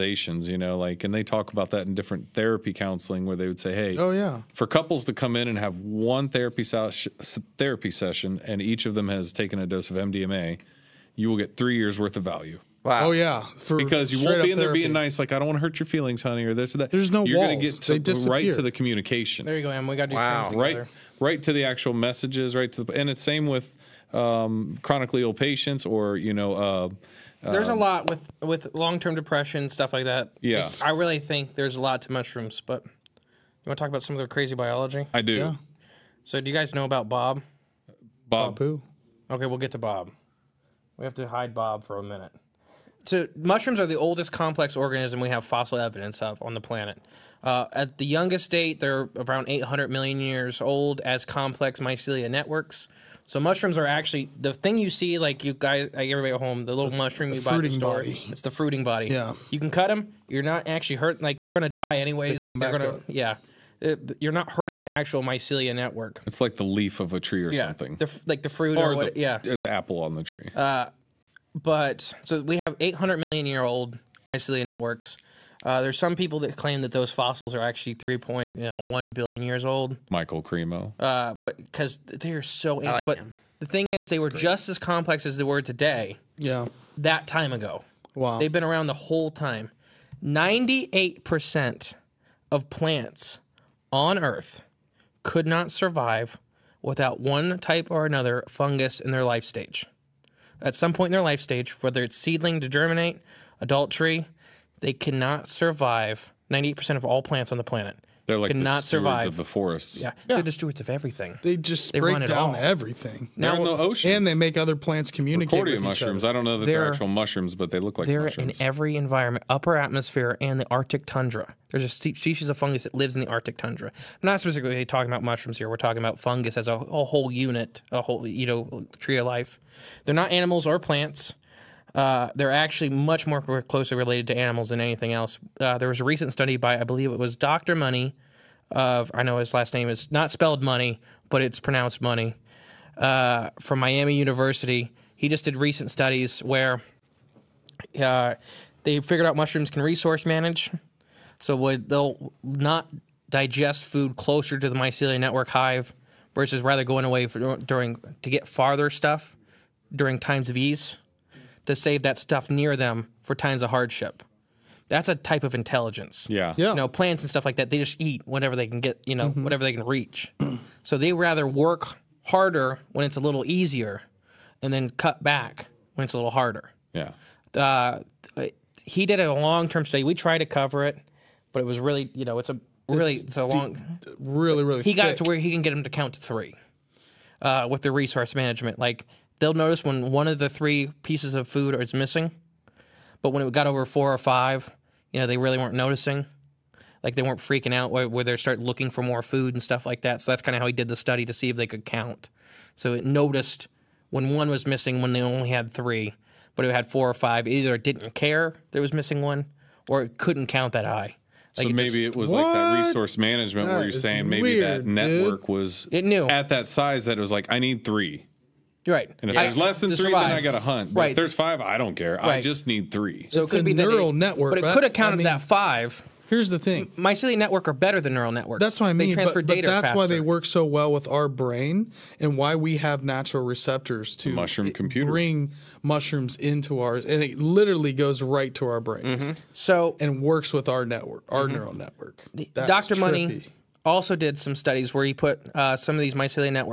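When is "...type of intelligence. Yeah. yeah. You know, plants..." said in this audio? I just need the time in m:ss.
2:45.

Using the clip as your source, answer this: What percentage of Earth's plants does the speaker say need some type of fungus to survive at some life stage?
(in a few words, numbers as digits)
98%.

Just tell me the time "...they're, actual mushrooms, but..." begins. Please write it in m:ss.
1:56.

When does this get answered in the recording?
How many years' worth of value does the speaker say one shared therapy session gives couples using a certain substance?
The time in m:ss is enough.
0:11.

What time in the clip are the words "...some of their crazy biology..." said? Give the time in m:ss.
0:34.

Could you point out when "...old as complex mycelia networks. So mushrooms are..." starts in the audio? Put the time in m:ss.
0:50.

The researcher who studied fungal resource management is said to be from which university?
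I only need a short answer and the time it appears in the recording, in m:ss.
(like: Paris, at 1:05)
Miami University, at 2:23.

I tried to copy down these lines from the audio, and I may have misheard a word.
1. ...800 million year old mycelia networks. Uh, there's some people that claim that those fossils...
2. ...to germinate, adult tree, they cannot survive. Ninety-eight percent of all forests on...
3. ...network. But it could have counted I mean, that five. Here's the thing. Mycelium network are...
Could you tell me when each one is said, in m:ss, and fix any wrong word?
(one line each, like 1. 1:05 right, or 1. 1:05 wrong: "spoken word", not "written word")
1. 1:12 right
2. 1:42 wrong: "plants", not "forests"
3. 3:44 right.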